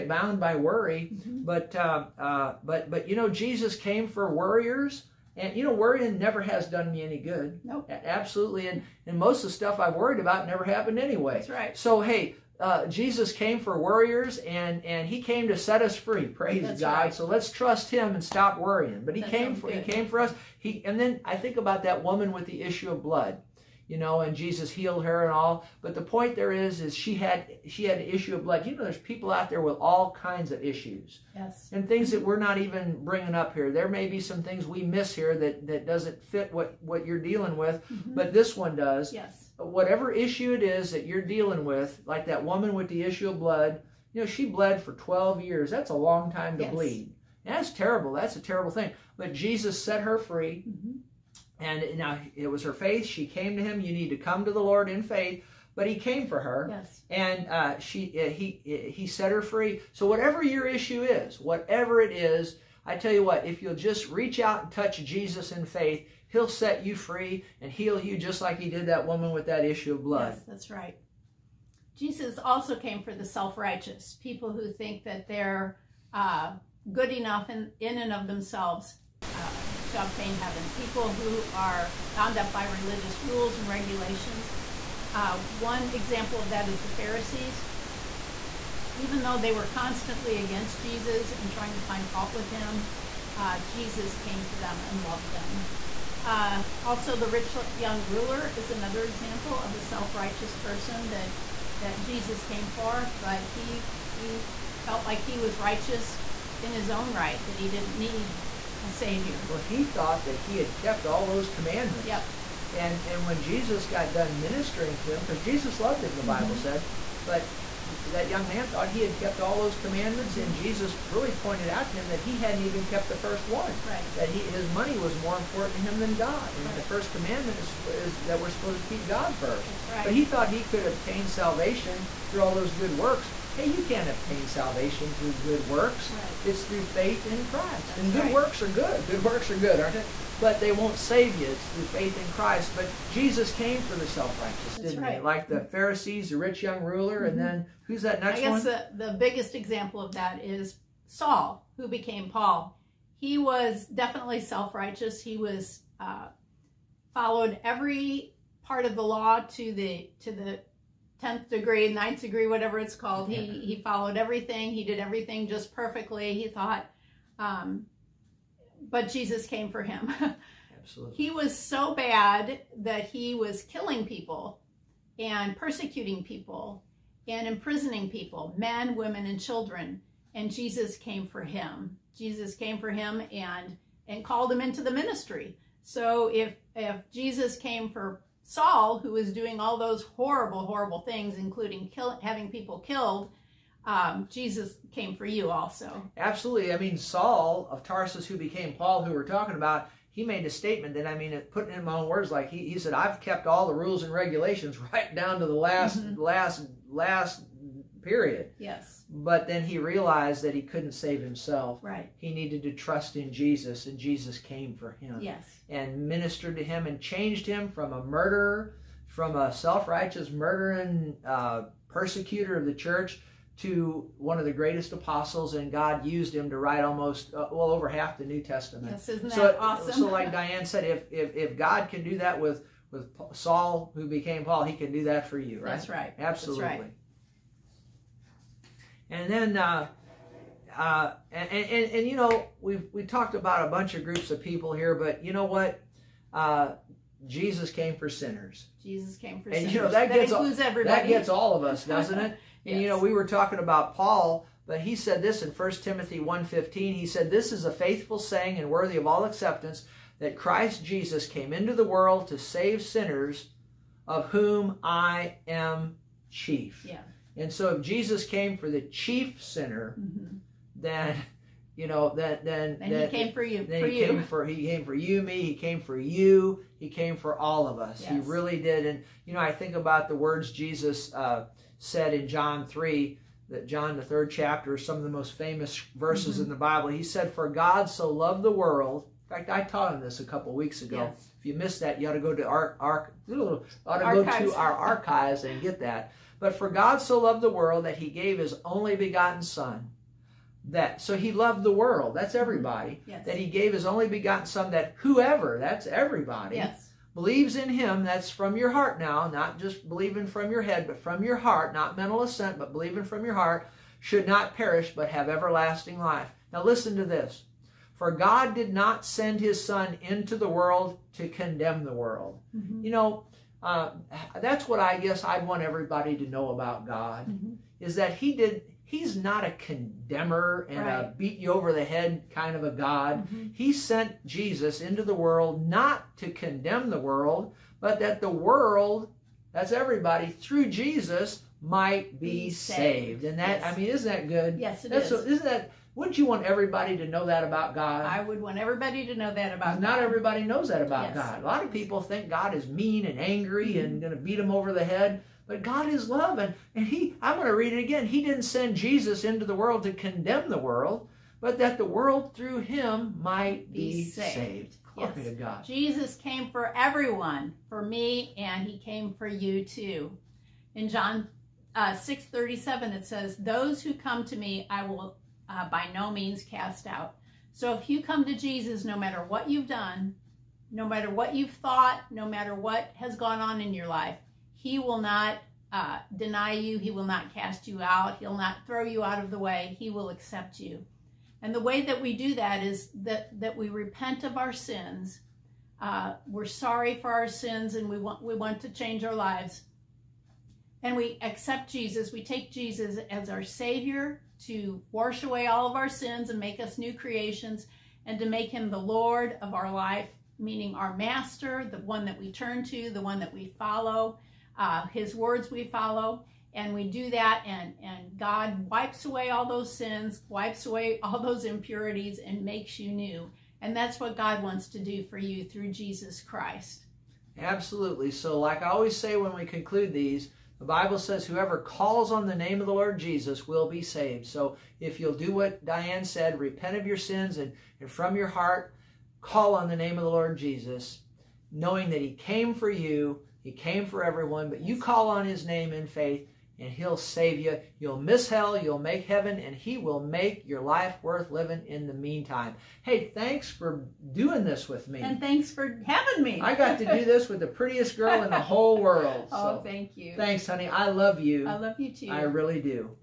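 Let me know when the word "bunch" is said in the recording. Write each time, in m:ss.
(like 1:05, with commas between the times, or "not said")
4:03.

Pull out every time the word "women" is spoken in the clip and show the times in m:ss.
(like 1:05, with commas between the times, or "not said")
2:58.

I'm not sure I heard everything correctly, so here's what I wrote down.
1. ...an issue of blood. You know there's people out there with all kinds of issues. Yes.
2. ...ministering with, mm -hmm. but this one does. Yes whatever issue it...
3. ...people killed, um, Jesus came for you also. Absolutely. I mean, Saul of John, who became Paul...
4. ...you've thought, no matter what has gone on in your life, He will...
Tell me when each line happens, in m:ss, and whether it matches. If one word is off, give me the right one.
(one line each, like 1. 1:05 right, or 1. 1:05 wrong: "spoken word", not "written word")
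1. 0:27 right
2. 0:37 wrong: "dealing", not "ministering"
3. 3:12 wrong: "Tarsus", not "John"
4. 6:21 right.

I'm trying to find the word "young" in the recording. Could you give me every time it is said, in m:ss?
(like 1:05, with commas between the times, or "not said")
1:37, 1:58, 2:26.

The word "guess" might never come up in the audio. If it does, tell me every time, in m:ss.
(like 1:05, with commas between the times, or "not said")
2:28, 5:24.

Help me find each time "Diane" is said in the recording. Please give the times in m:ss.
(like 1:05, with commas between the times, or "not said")
3:50, 7:15.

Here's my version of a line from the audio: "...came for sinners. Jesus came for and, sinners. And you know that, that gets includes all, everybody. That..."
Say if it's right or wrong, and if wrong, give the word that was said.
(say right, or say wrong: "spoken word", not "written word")
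right.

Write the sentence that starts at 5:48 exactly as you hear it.
I would want everybody to know that about God.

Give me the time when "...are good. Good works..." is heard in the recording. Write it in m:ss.
2:18.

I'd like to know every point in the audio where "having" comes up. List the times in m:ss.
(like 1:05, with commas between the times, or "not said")
3:12, 7:35.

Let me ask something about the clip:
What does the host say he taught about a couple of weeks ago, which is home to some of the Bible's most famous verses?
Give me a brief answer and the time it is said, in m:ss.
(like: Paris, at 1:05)
John chapter 3, at 4:42.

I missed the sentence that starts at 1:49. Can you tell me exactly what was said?
Well, he thought that he had kept all those commandments.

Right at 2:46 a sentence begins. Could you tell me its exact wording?
He thought, um, but Jesus came for him.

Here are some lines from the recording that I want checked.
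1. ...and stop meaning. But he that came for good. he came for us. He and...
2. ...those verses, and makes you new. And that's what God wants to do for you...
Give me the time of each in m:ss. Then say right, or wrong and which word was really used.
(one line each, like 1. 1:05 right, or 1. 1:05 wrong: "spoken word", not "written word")
1. 0:18 wrong: "worrying", not "meaning"
2. 7:01 wrong: "impurities", not "verses".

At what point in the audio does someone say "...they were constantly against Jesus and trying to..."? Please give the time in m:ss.
1:29.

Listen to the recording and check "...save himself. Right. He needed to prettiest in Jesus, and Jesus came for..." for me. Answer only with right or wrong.
wrong.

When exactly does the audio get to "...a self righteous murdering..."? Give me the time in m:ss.
3:39.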